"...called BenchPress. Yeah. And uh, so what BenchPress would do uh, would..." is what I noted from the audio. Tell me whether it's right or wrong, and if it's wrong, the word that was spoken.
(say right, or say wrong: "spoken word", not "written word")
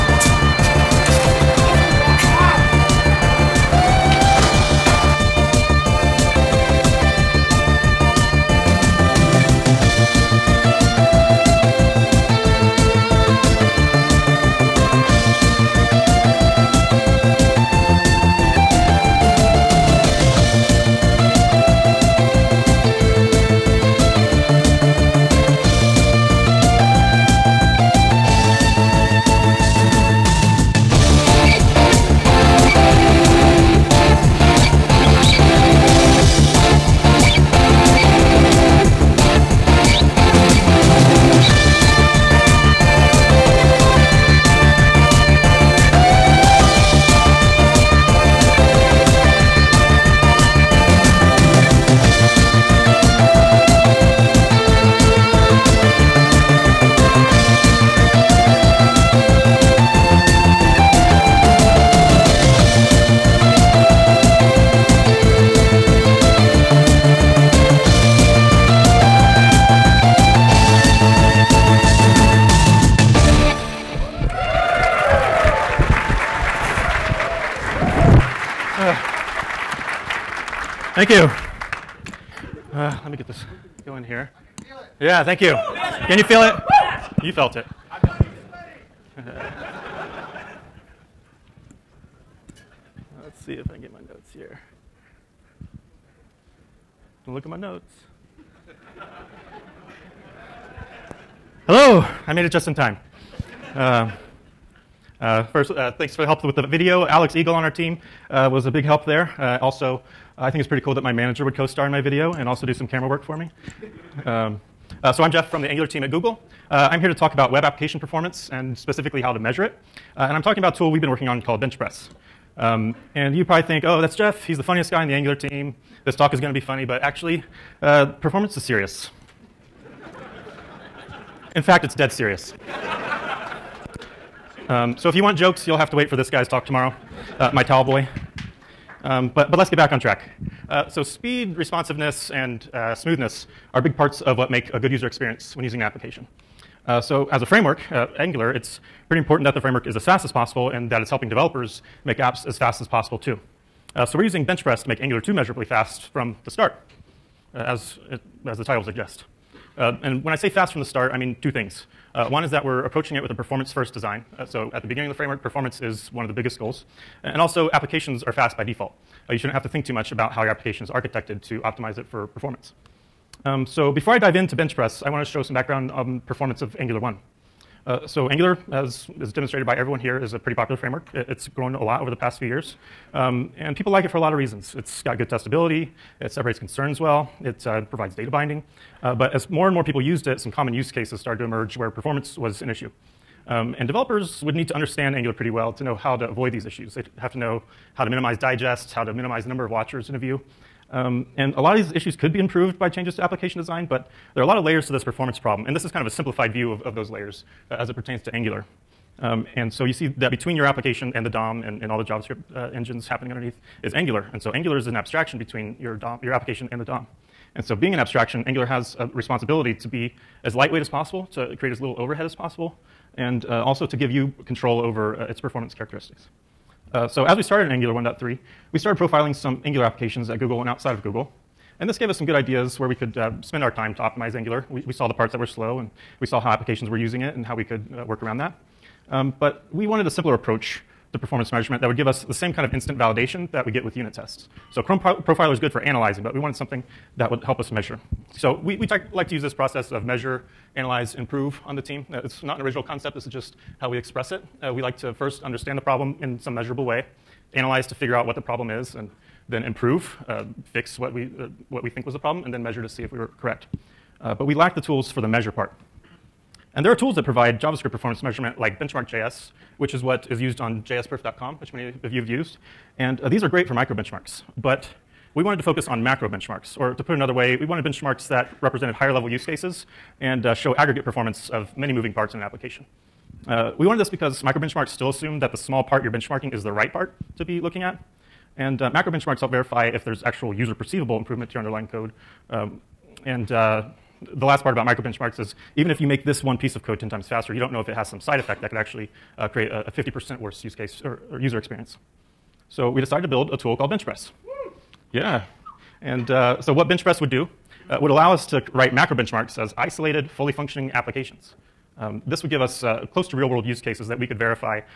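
right.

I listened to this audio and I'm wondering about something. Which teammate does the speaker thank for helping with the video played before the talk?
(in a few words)
Alex Eagle.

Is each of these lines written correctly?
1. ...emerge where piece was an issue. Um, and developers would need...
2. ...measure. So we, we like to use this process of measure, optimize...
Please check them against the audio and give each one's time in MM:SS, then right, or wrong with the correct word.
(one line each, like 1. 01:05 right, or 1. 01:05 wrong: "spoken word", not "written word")
1. 03:11 wrong: "performance", not "piece"
2. 04:07 wrong: "analyze", not "optimize".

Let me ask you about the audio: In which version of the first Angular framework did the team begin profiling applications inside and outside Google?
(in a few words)
1.3.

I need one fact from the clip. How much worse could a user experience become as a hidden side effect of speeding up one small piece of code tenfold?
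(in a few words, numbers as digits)
50%.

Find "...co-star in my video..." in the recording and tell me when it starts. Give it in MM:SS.
01:51.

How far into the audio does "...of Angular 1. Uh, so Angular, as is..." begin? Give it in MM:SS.
02:56.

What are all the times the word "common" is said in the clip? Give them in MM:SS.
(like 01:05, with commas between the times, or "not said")
03:10.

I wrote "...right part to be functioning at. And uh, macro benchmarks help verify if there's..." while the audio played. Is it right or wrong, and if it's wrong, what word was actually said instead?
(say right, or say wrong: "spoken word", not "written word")
wrong: "looking", not "functioning".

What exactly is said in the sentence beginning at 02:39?
Uh, and when I say fast from the start, I mean two things.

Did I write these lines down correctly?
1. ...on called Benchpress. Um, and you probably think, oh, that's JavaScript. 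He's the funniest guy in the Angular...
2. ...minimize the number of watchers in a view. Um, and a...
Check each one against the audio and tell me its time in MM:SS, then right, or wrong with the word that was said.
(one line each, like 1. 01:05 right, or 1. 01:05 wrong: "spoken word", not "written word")
1. 02:01 wrong: "Jeff", not "JavaScript"
2. 03:19 right.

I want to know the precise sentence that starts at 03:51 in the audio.
And this gave us some good ideas where we could uh, spend our time to optimize Angular.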